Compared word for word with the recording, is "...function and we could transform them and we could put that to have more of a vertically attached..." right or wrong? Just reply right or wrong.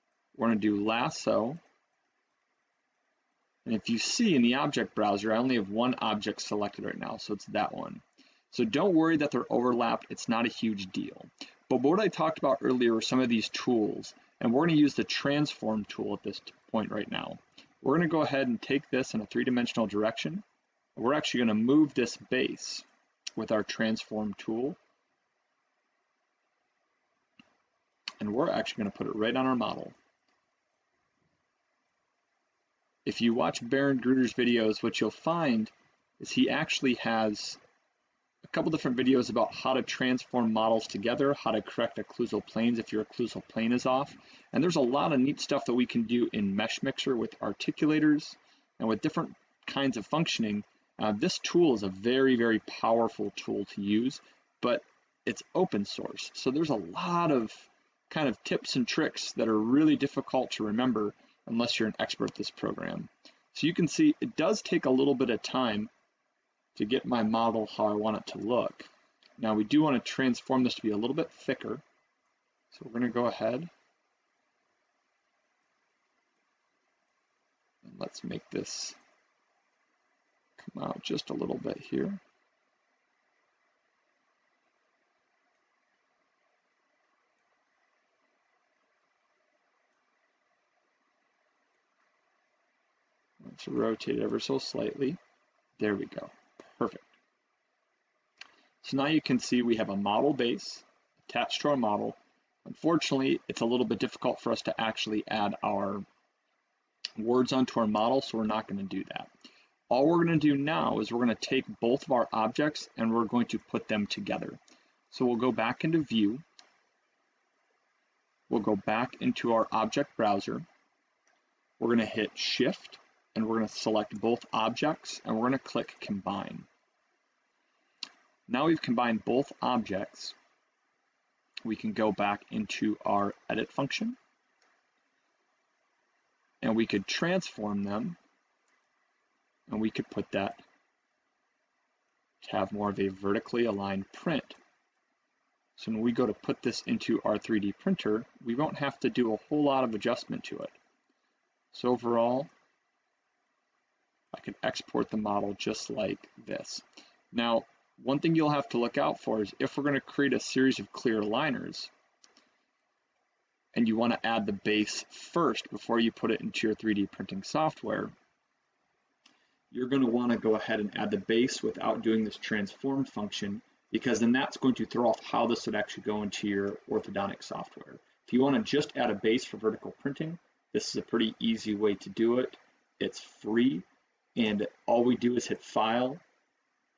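wrong.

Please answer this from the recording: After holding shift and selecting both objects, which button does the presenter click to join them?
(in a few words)
Combine.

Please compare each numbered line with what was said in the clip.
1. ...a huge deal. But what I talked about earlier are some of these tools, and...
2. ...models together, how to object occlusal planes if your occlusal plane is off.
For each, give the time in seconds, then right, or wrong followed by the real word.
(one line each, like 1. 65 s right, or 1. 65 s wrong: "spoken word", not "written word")
1. 10 s right
2. 40 s wrong: "correct", not "object".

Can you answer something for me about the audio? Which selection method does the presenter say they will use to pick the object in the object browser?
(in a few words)
Lasso.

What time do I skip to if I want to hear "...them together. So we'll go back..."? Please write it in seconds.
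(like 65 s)
113 s.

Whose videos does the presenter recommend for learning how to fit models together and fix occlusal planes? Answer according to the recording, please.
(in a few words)
Baron Gruder.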